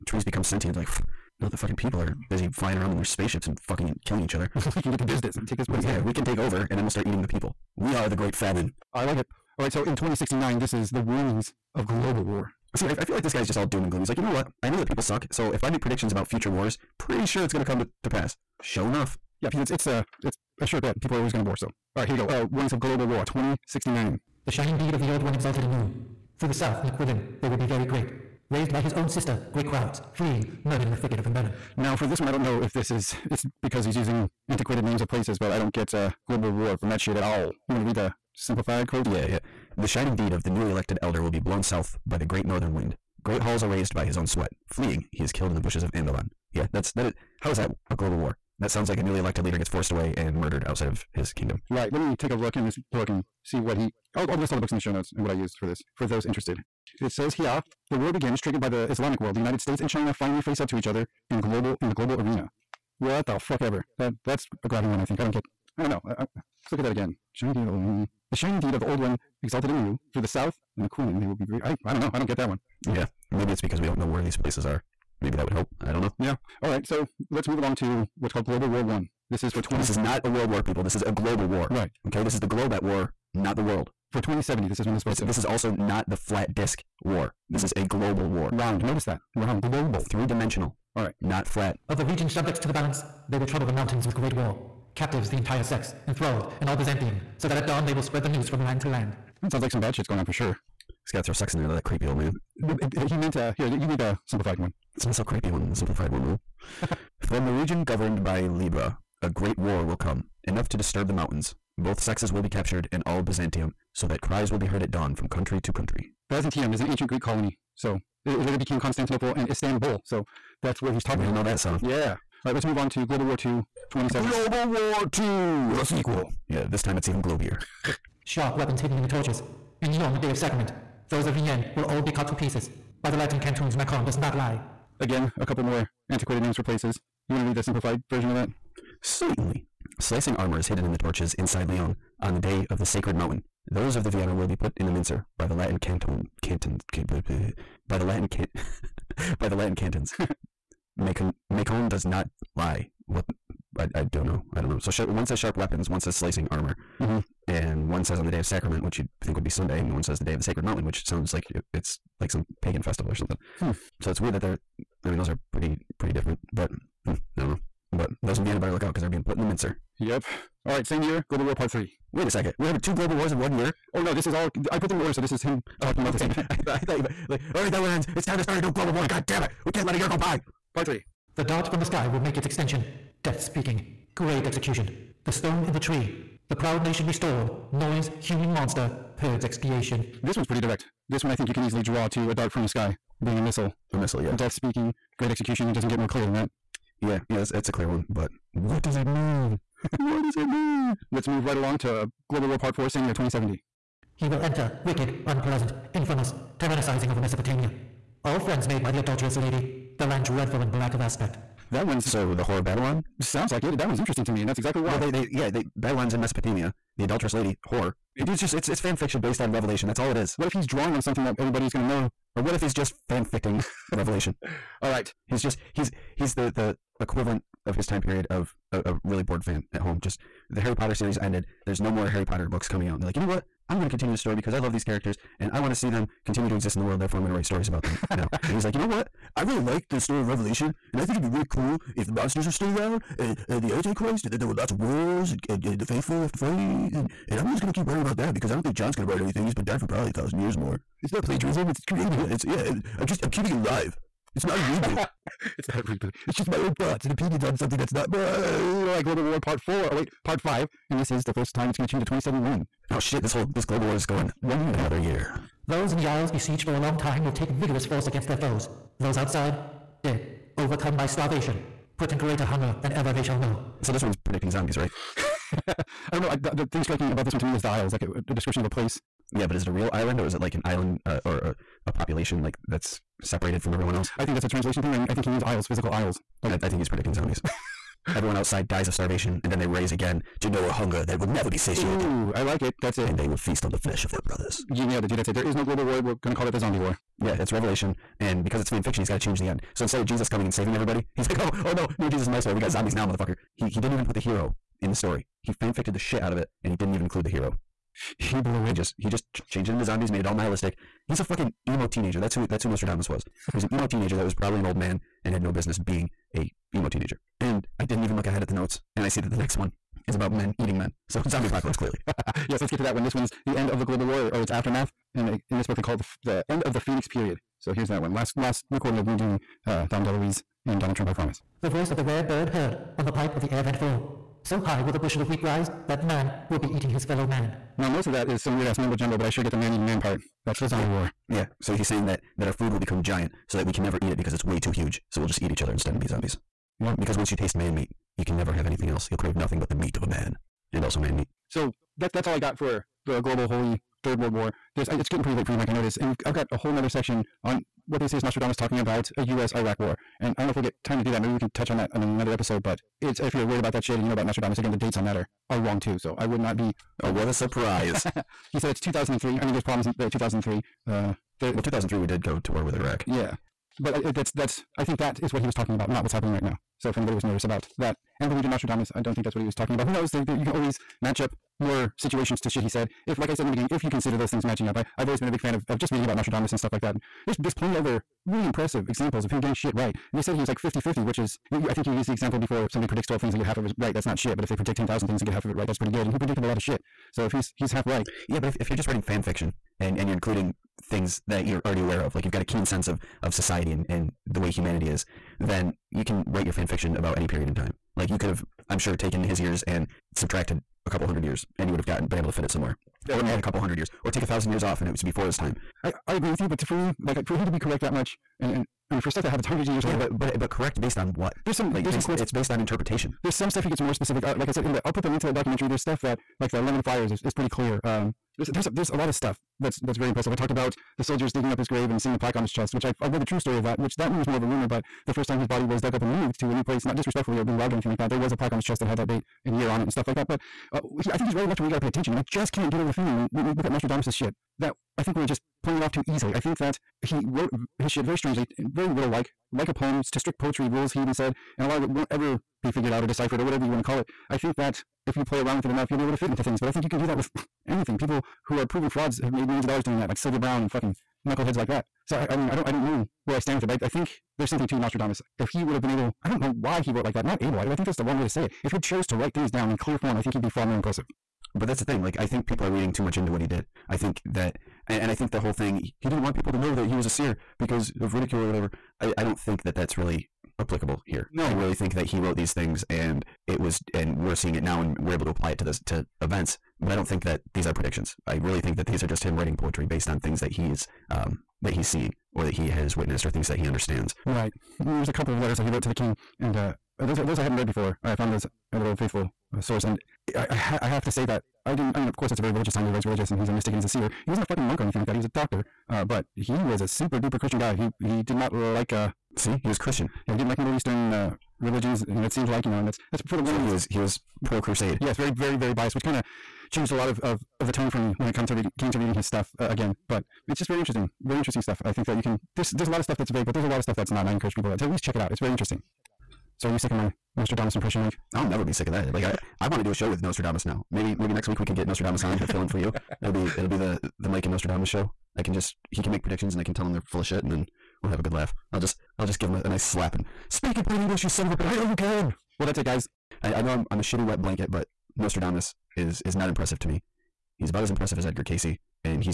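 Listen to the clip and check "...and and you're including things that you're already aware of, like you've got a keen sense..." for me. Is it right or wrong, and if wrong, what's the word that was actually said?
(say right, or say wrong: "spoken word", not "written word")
right.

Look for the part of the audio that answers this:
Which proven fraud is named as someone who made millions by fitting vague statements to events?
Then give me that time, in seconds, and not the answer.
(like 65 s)
460 s.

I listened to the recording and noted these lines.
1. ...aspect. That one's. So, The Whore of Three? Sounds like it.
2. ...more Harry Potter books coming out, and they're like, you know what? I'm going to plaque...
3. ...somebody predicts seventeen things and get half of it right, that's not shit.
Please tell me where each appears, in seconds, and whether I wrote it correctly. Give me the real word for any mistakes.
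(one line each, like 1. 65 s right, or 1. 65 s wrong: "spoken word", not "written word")
1. 211 s wrong: "Babylon", not "Three"
2. 231 s wrong: "continue", not "plaque"
3. 392 s wrong: "twelve", not "seventeen".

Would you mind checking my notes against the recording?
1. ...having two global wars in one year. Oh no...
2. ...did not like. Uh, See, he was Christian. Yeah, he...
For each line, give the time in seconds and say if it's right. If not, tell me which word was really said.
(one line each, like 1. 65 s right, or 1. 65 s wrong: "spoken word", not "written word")
1. 172 s right
2. 508 s right.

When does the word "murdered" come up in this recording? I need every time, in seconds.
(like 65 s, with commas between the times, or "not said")
30 s, 50 s.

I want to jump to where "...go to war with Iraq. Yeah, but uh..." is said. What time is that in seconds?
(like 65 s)
372 s.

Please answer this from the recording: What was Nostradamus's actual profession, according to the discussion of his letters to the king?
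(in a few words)
doctor.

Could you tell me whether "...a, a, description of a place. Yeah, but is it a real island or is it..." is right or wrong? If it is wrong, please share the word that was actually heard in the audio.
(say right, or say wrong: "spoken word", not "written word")
right.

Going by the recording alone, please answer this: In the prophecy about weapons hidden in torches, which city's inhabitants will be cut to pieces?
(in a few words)
Vienne.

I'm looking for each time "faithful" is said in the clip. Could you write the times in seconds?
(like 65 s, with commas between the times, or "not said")
245 s, 498 s.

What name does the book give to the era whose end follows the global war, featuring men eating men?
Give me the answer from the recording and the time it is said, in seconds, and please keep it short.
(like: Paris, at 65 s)
the Phoenix period, at 326 s.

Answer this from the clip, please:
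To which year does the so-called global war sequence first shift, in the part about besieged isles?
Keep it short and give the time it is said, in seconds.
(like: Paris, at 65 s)
2071, at 262 s.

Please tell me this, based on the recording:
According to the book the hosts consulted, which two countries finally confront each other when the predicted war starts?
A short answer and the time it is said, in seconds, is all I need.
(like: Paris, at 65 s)
United States and China, at 59 s.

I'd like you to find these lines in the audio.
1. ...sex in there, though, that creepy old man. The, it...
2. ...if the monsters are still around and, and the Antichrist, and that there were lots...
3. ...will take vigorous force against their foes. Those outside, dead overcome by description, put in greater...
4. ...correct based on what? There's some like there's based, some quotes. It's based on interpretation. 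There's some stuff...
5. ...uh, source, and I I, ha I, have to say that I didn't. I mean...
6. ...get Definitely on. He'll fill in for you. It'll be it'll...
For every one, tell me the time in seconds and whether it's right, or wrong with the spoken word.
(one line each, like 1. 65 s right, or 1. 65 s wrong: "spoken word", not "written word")
1. 101 s right
2. 241 s right
3. 267 s wrong: "starvation", not "description"
4. 420 s right
5. 499 s right
6. 531 s wrong: "Nostradamus", not "Definitely".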